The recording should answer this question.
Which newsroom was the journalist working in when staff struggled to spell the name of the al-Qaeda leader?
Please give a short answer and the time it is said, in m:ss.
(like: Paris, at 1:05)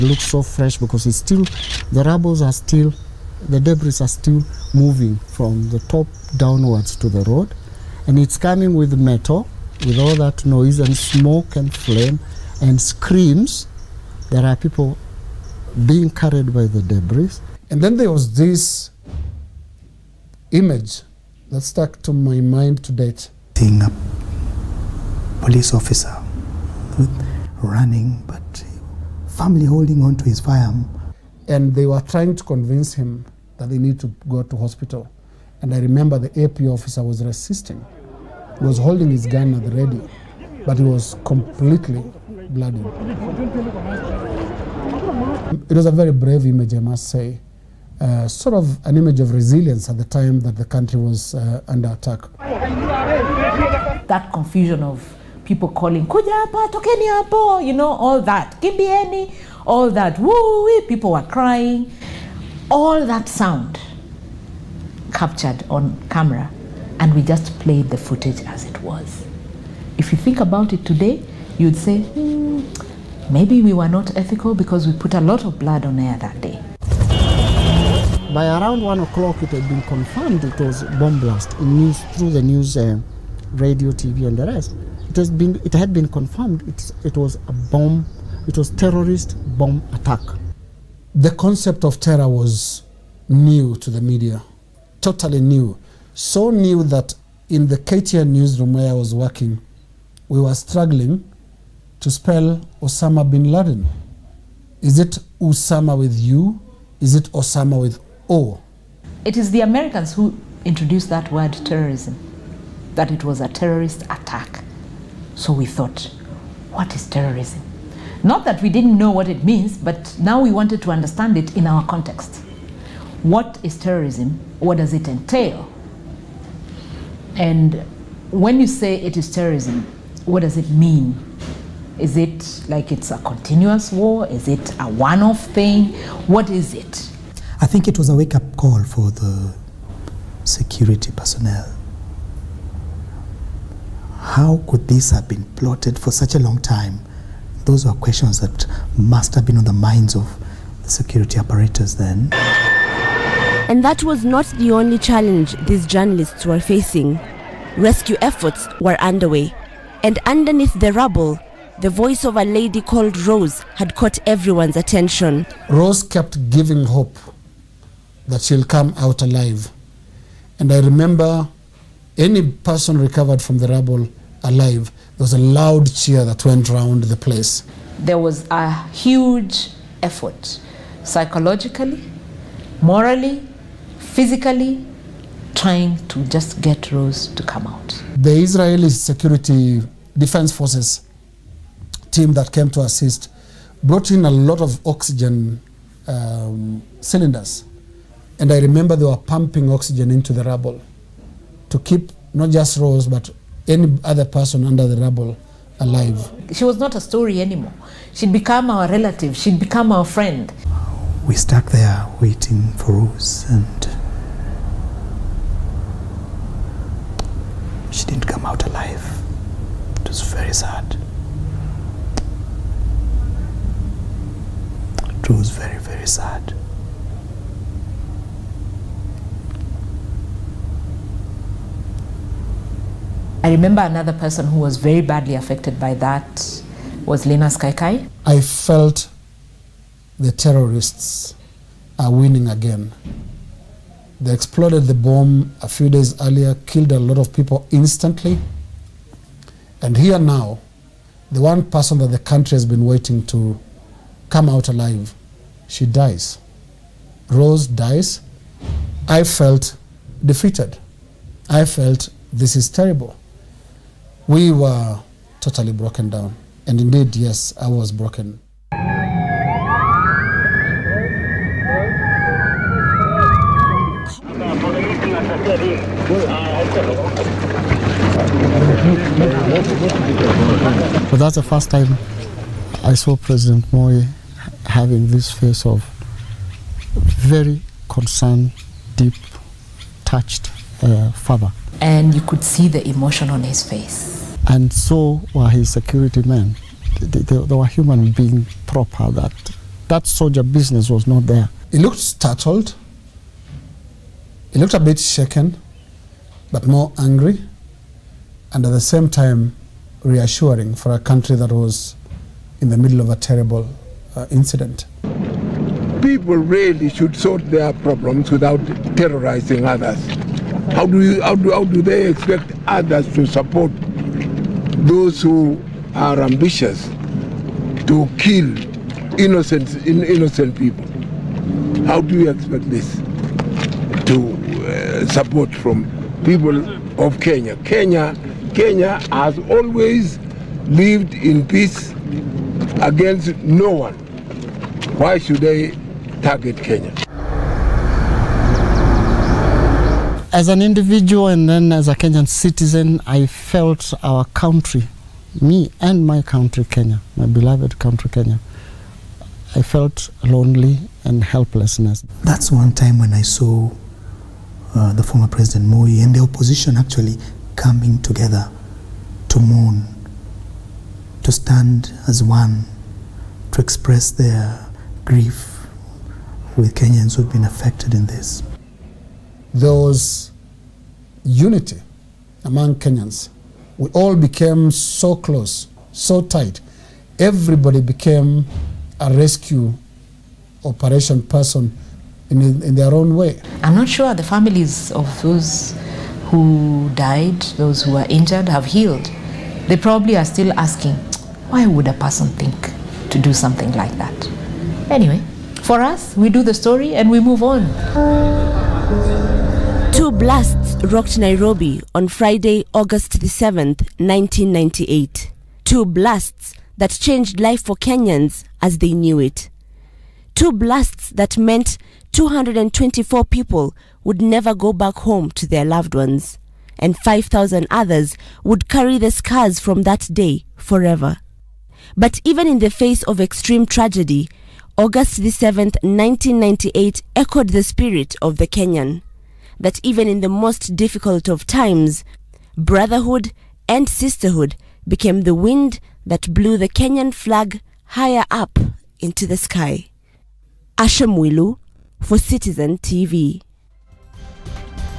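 KTN, at 1:37.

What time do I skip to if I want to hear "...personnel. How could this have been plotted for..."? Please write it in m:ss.
2:21.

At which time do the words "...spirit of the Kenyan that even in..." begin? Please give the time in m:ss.
7:17.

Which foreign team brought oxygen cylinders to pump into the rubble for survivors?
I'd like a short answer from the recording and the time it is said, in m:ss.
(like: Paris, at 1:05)
Israeli security defense forces, at 3:08.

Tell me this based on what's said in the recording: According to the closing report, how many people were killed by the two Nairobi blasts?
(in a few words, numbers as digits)
224.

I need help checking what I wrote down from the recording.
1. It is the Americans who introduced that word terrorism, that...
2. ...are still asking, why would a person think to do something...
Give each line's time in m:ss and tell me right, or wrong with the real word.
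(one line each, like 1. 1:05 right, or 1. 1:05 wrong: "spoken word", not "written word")
1. 1:49 right
2. 6:40 right.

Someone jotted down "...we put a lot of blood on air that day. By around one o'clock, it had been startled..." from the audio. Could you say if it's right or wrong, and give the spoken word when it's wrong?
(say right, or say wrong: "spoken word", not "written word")
wrong: "confirmed", not "startled".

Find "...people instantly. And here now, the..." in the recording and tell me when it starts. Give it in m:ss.
4:07.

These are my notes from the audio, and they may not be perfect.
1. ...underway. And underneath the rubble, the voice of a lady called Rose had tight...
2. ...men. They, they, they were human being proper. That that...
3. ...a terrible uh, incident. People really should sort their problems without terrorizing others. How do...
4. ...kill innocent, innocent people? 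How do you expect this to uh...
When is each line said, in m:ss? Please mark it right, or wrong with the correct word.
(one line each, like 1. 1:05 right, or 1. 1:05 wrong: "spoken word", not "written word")
1. 2:38 wrong: "caught", not "tight"
2. 4:56 right
3. 5:13 right
4. 5:28 right.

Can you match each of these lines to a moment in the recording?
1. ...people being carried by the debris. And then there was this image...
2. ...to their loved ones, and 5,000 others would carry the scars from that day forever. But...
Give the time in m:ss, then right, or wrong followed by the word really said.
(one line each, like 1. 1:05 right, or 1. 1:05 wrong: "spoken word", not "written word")
1. 0:14 right
2. 7:05 right.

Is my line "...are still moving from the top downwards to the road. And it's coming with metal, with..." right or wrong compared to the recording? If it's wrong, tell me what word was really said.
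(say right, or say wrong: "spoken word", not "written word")
right.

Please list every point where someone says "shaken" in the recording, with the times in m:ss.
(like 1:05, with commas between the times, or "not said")
5:04.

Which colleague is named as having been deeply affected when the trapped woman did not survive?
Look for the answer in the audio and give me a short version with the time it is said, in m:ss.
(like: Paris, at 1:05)
Linus Kaikai, at 3:57.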